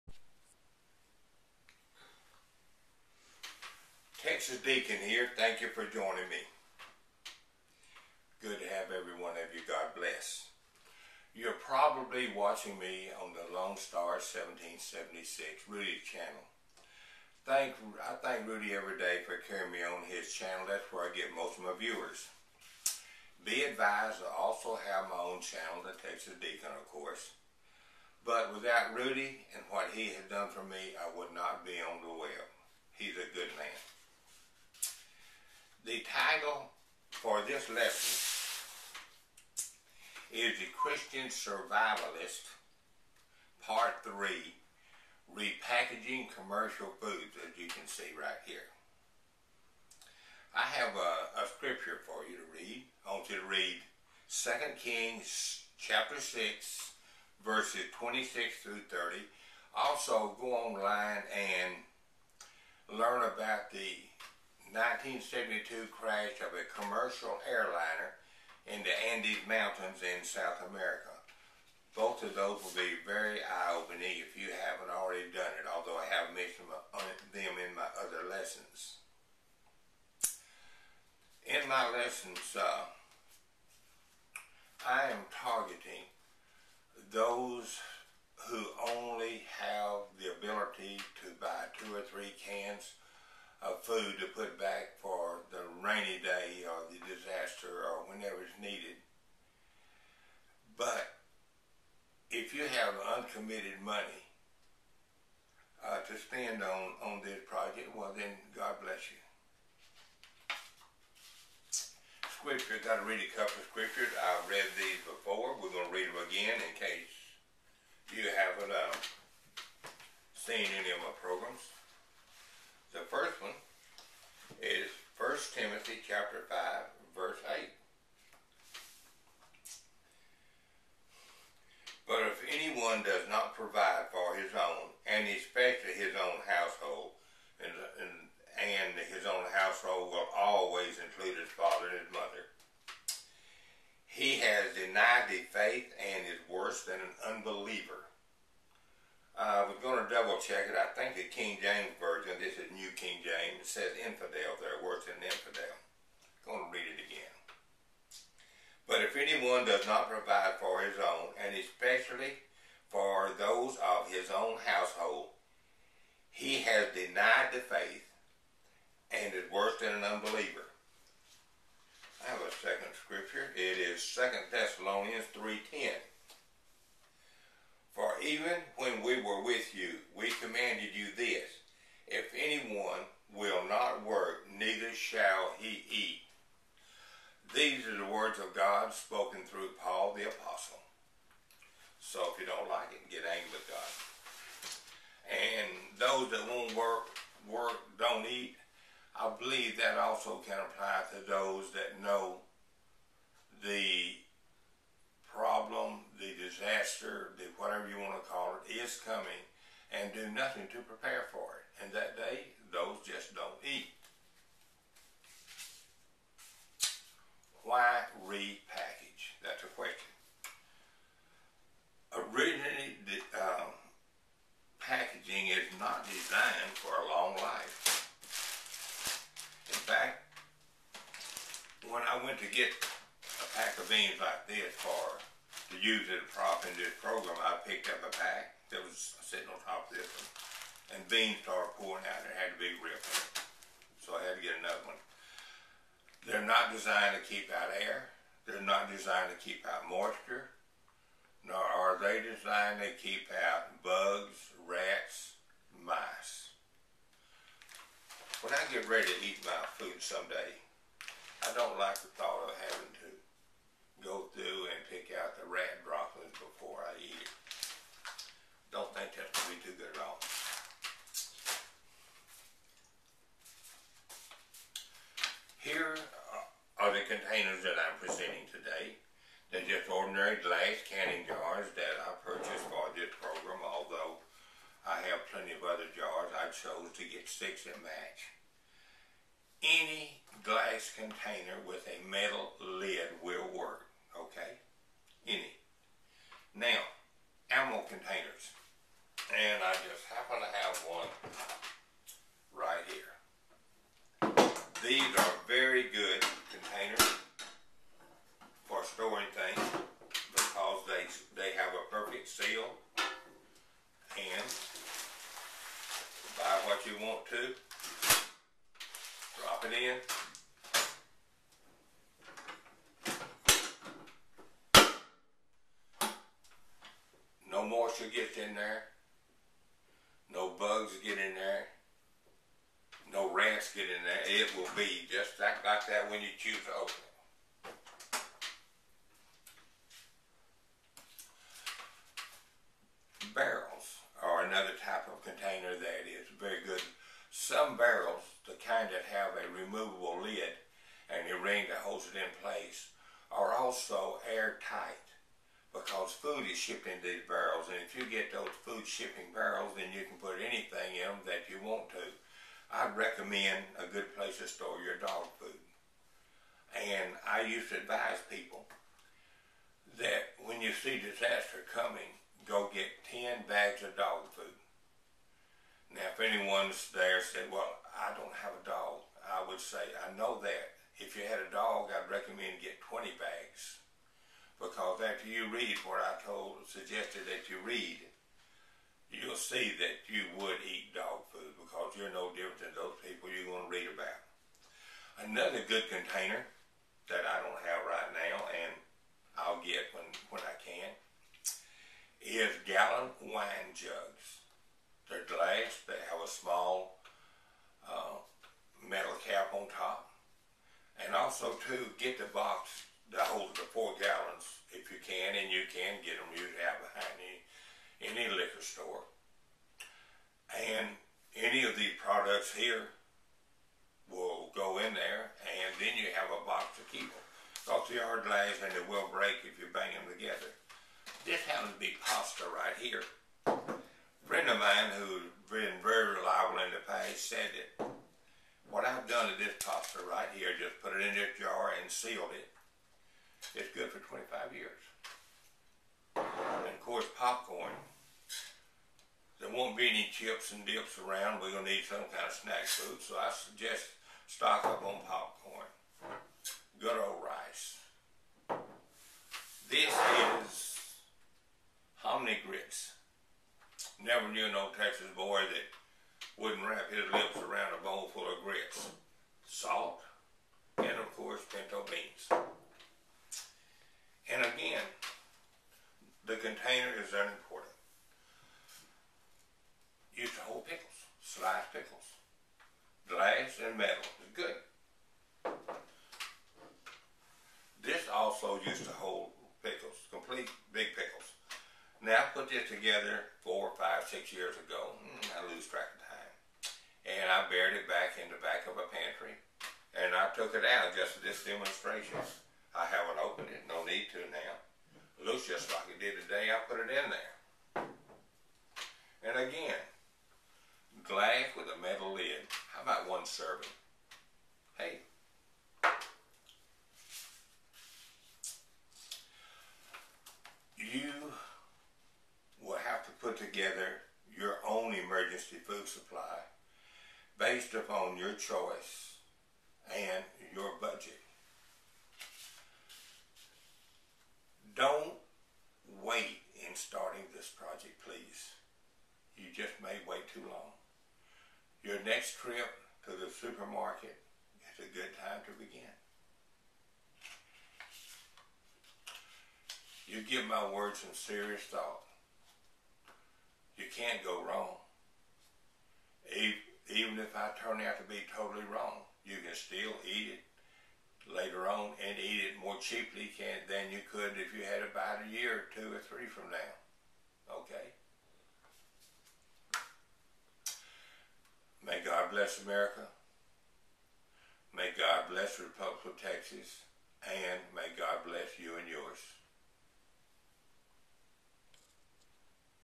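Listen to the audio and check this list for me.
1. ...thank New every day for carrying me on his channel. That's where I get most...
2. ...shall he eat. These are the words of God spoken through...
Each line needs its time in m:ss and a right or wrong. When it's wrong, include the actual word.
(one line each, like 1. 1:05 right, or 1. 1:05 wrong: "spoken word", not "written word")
1. 0:18 wrong: "Rudy", not "New"
2. 3:04 right.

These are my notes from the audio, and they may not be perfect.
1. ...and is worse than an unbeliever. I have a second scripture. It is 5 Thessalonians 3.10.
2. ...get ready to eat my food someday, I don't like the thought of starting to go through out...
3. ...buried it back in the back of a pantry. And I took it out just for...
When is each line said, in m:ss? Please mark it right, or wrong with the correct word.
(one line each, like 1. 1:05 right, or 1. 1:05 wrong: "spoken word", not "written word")
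1. 2:49 wrong: "2", not "5"
2. 4:18 wrong: "having", not "starting"
3. 8:17 right.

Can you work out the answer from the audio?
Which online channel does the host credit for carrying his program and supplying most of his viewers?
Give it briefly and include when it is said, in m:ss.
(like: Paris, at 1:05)
Lone Star 1776 Rudy channel, at 0:13.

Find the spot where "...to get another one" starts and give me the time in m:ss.
4:04.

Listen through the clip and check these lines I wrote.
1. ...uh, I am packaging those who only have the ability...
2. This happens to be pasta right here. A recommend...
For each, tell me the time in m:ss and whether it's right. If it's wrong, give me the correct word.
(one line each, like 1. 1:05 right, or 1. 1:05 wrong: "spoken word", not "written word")
1. 1:22 wrong: "targeting", not "packaging"
2. 7:11 wrong: "friend", not "recommend".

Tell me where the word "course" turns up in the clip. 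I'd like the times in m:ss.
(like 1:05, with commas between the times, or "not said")
0:26, 7:26, 7:51.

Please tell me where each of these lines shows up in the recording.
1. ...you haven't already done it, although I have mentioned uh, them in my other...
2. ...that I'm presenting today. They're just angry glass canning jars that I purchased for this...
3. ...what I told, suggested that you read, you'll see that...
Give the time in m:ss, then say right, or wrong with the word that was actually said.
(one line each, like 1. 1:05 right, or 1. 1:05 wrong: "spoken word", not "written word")
1. 1:14 right
2. 4:37 wrong: "ordinary", not "angry"
3. 6:25 right.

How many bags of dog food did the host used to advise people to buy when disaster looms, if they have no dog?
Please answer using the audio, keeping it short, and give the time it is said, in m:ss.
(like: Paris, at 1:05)
10, at 6:13.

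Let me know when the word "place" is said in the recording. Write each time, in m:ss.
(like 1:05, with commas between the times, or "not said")
5:52, 6:04.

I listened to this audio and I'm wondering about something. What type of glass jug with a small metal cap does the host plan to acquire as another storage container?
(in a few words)
Gallon wine jugs.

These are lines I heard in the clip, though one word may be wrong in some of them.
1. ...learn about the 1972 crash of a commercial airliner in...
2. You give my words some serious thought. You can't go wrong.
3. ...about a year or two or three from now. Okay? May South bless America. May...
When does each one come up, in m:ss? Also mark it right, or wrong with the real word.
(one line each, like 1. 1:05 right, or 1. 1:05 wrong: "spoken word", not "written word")
1. 1:02 right
2. 9:10 right
3. 9:24 wrong: "God", not "South".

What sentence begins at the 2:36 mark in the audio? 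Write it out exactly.
I'm going to read it again.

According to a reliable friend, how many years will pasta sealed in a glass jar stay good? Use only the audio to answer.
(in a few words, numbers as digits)
25 years.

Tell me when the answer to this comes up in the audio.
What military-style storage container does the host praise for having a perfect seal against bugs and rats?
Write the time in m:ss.
4:57.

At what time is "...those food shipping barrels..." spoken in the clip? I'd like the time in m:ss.
5:58.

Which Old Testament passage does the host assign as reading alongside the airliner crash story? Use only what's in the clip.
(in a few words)
2 Kings 6:26-30.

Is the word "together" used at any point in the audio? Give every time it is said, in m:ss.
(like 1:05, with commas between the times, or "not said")
7:10, 8:12.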